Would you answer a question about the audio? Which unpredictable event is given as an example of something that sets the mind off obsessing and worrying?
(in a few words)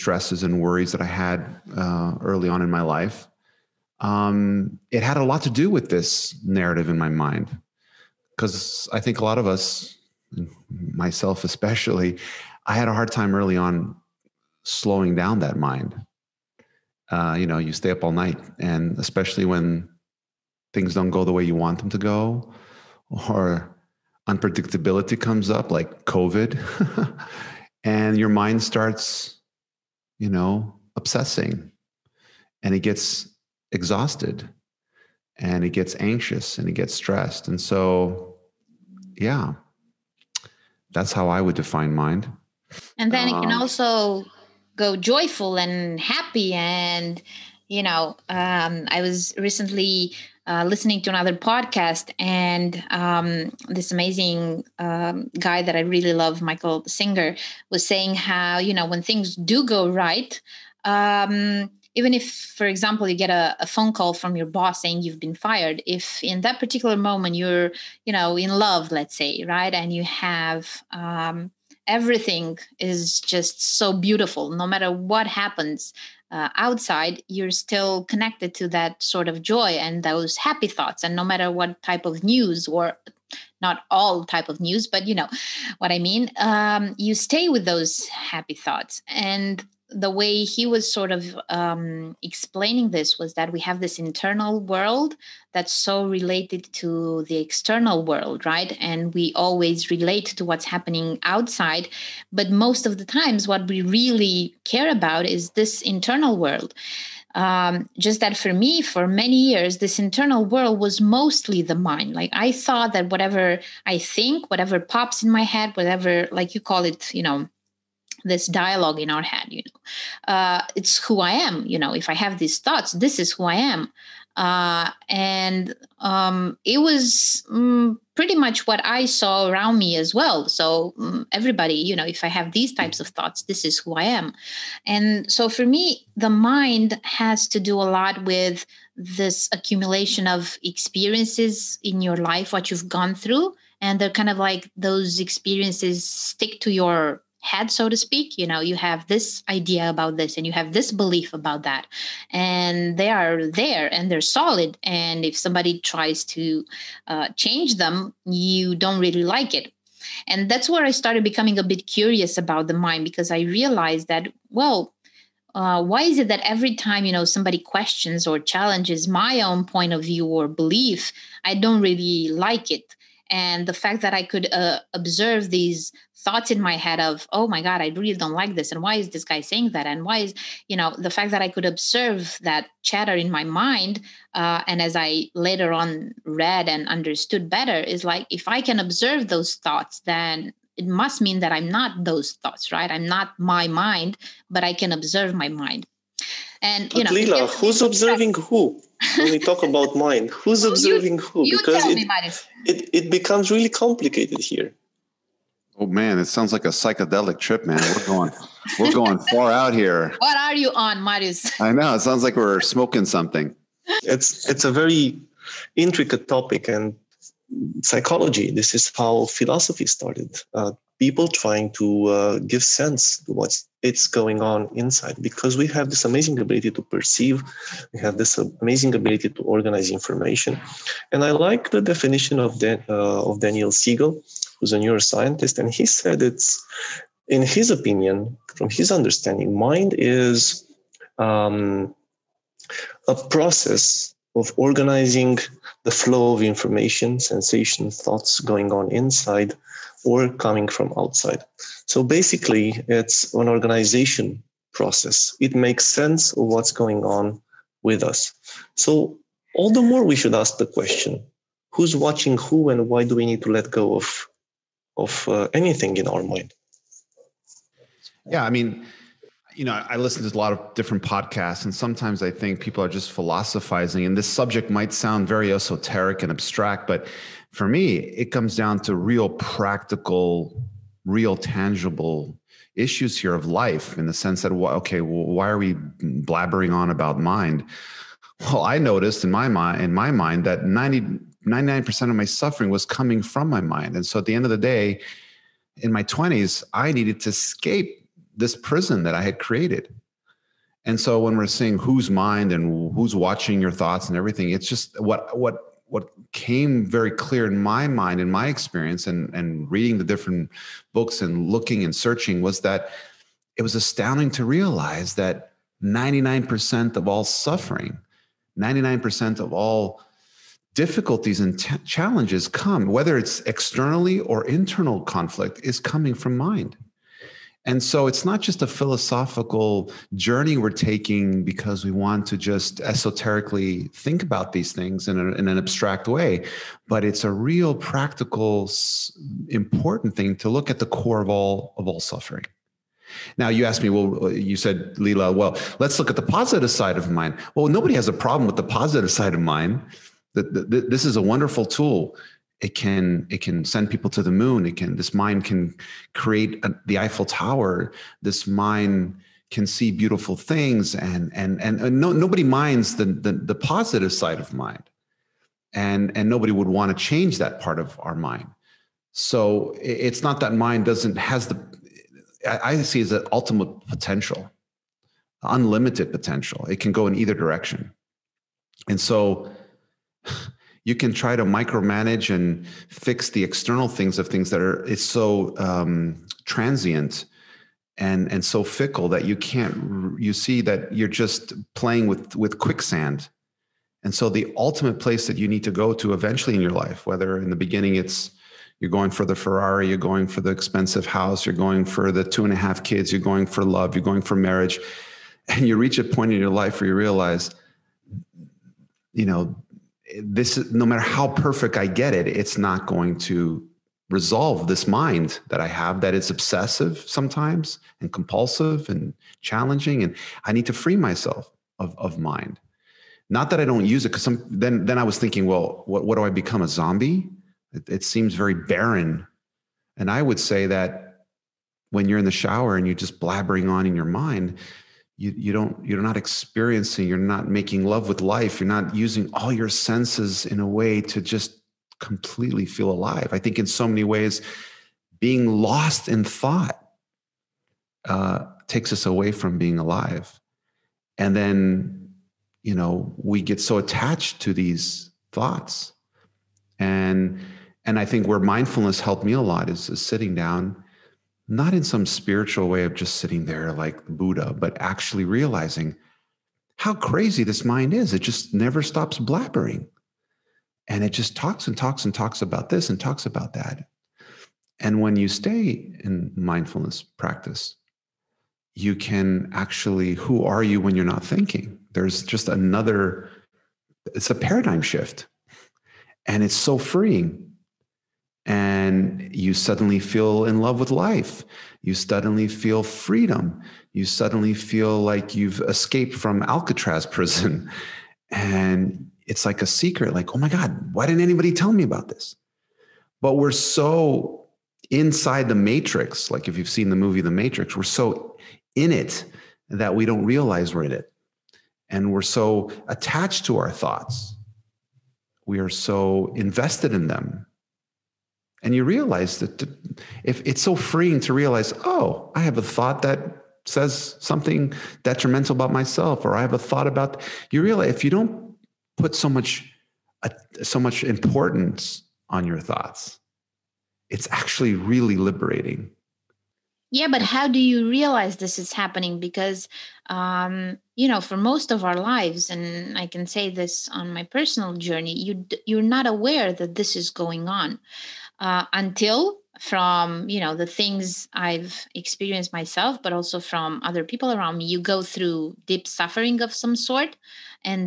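COVID.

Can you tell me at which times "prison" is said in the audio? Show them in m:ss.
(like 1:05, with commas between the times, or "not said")
4:58, 8:17.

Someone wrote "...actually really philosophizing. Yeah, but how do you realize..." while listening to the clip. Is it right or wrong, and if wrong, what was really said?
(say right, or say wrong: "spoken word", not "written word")
wrong: "liberating", not "philosophizing".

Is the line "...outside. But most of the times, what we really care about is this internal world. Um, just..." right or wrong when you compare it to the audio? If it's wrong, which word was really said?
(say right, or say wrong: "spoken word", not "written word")
right.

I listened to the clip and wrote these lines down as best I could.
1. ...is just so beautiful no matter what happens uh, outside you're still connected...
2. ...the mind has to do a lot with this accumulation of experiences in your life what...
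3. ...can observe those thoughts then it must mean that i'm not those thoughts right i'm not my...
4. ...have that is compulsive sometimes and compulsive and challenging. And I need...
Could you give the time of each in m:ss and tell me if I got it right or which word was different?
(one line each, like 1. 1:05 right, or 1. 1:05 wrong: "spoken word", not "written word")
1. 1:12 right
2. 2:16 right
3. 3:08 right
4. 6:55 wrong: "obsessive", not "compulsive".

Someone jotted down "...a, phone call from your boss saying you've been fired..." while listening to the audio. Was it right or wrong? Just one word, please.
right.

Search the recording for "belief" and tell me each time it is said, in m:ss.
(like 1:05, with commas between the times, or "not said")
2:30, 2:50.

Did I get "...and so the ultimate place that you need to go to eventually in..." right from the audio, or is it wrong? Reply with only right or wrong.
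right.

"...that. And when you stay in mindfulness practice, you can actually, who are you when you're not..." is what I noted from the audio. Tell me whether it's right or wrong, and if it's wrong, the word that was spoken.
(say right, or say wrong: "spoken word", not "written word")
right.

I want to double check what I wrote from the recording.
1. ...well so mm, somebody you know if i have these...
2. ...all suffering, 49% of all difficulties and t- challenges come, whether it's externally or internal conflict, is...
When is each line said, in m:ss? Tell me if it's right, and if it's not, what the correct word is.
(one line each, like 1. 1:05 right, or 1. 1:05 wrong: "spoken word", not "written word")
1. 2:10 wrong: "everybody", not "somebody"
2. 5:17 wrong: "99", not "49".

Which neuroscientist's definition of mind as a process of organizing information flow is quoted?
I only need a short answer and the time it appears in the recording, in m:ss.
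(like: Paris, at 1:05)
Daniel Siegel, at 3:53.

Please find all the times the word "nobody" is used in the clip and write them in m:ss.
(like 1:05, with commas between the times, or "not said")
5:47, 6:02, 6:06.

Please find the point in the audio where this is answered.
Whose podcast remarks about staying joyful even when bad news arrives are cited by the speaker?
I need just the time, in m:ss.
0:56.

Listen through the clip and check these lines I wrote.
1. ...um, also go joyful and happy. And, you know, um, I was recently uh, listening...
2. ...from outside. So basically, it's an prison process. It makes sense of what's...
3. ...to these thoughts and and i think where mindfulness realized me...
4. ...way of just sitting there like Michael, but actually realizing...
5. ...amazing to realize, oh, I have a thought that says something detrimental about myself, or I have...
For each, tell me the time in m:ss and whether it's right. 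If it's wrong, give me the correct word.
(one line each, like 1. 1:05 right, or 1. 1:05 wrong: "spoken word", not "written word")
1. 0:43 right
2. 4:10 wrong: "organization", not "prison"
3. 7:34 wrong: "helped", not "realized"
4. 7:42 wrong: "Buddha", not "Michael"
5. 8:40 wrong: "freeing", not "amazing".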